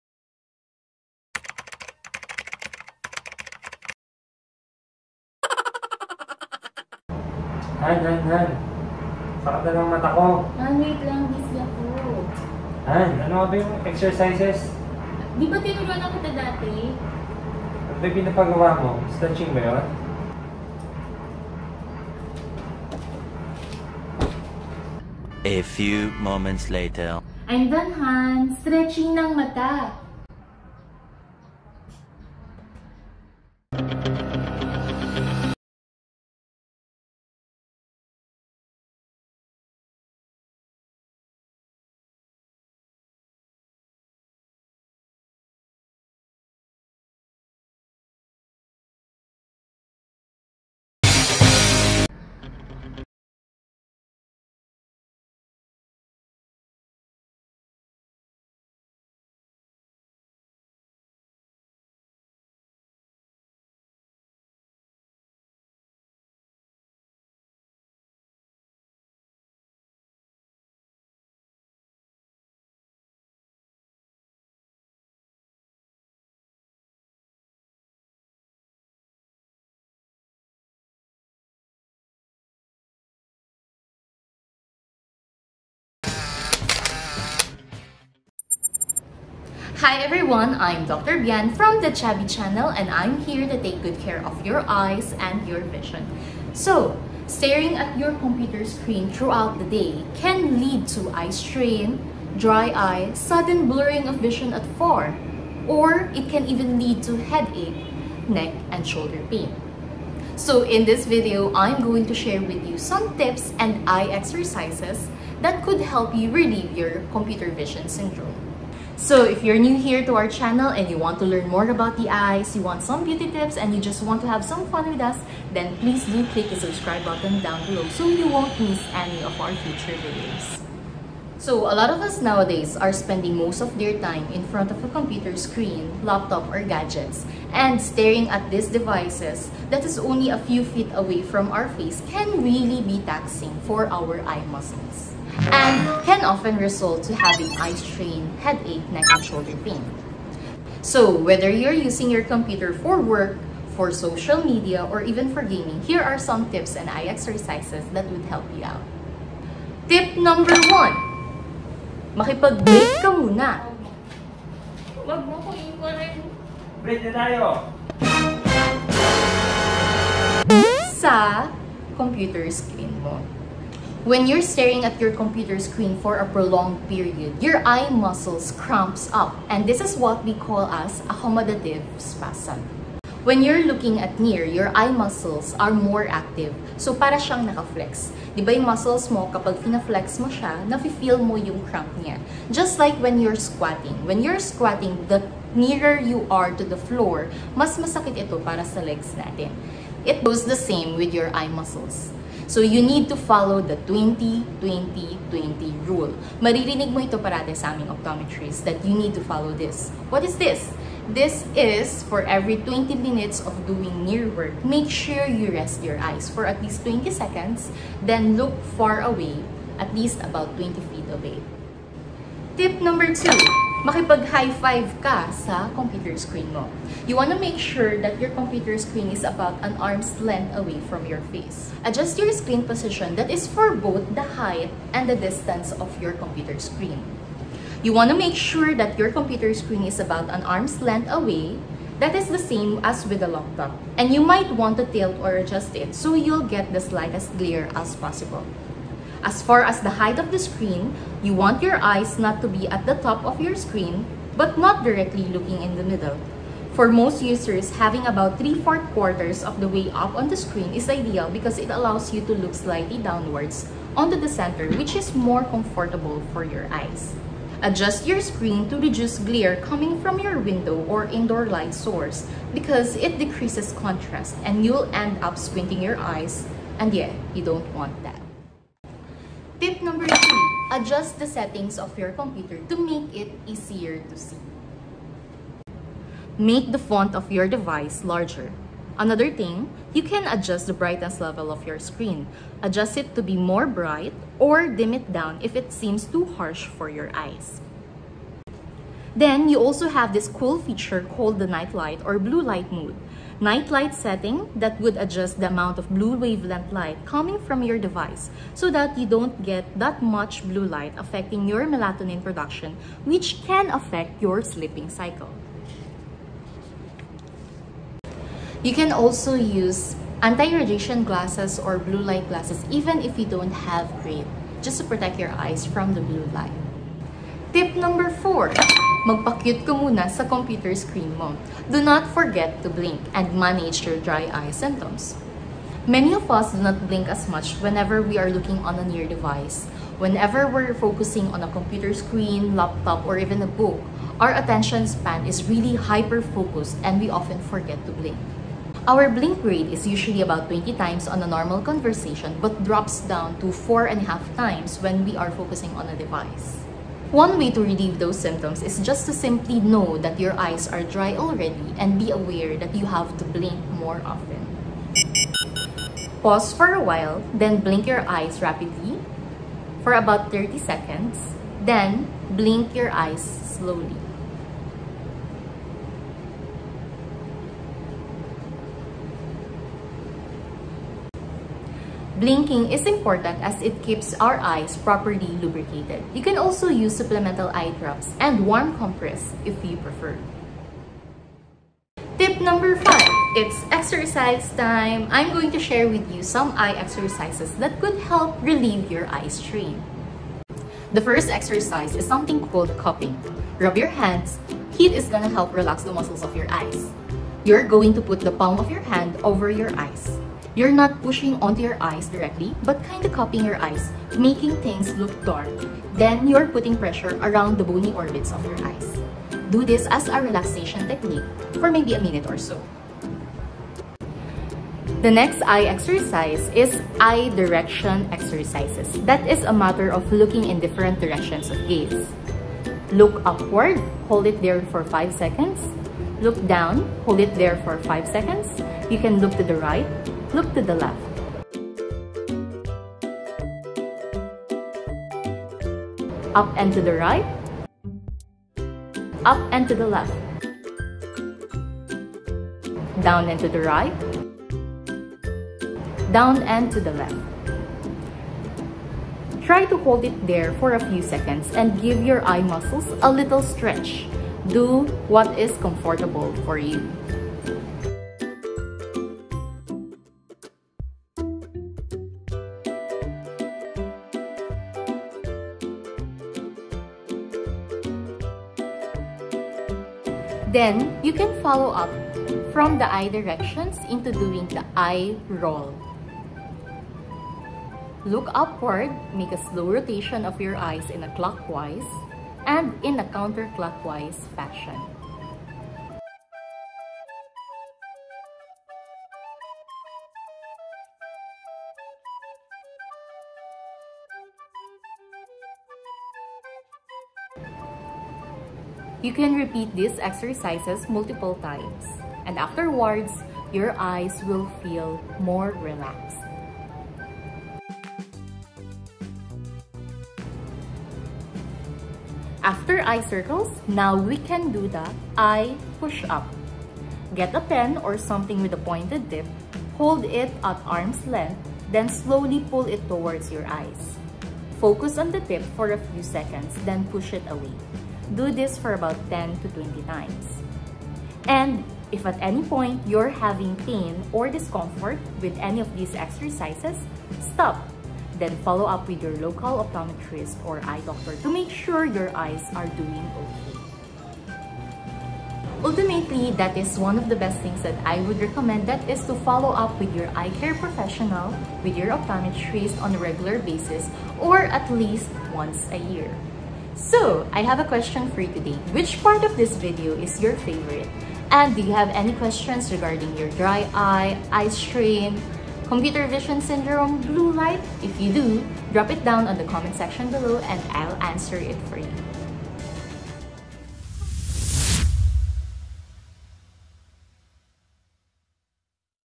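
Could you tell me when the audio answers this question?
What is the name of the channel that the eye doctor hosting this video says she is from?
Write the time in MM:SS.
01:31.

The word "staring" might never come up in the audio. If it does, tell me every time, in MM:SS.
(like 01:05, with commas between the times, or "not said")
01:37, 02:17, 02:54.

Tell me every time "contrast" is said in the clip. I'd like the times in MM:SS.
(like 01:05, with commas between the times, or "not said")
04:33.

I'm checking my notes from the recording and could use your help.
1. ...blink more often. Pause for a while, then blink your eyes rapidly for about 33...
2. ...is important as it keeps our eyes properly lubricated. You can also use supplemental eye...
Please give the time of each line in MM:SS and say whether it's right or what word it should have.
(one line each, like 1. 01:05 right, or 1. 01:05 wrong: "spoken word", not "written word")
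1. 06:03 wrong: "30", not "33"
2. 06:22 right.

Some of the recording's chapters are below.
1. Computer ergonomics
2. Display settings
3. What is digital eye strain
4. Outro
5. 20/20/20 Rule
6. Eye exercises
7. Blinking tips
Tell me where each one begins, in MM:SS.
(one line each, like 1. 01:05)
1. 03:42
2. 04:40
3. 02:11
4. 09:20
5. 02:39
6. 06:31
7. 05:28.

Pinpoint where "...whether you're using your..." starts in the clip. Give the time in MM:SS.
02:31.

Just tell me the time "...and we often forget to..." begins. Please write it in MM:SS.
05:46.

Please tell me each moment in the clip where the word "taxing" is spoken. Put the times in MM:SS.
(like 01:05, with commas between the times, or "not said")
02:23.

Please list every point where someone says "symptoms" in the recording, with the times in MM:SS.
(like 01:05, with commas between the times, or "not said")
05:34, 05:58.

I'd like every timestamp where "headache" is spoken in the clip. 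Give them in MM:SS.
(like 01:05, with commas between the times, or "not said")
01:47, 02:28.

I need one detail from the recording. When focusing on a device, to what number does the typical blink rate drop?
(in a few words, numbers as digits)
4.5.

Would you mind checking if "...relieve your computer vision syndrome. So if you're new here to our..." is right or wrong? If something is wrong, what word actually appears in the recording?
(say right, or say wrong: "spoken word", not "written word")
right.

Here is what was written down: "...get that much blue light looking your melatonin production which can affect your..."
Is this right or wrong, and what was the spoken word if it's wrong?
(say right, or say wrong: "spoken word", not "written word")
wrong: "affecting", not "looking".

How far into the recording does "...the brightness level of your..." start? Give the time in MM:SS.
04:50.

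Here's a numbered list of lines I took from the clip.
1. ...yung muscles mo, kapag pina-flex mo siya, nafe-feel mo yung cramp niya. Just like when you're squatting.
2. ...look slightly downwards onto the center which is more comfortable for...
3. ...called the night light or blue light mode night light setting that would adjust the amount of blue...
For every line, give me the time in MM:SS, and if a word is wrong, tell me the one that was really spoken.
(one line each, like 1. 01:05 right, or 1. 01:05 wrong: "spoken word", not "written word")
1. 03:08 right
2. 04:22 right
3. 05:01 right.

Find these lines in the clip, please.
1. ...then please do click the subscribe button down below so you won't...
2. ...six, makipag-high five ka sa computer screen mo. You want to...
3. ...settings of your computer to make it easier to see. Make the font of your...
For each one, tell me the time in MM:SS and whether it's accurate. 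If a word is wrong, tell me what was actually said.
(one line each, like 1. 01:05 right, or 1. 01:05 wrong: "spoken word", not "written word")
1. 02:05 right
2. 03:43 wrong: "two", not "six"
3. 04:41 right.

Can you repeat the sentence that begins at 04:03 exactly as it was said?
And you might want to tilt or adjust it so you'll get the slightest glare as possible.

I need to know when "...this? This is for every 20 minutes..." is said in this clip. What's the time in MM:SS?
03:30.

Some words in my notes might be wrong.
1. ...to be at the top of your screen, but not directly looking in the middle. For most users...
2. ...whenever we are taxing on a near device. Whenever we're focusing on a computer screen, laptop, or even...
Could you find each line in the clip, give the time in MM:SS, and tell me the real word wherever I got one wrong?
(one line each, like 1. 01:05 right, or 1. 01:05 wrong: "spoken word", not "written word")
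1. 04:12 right
2. 05:37 wrong: "looking", not "taxing".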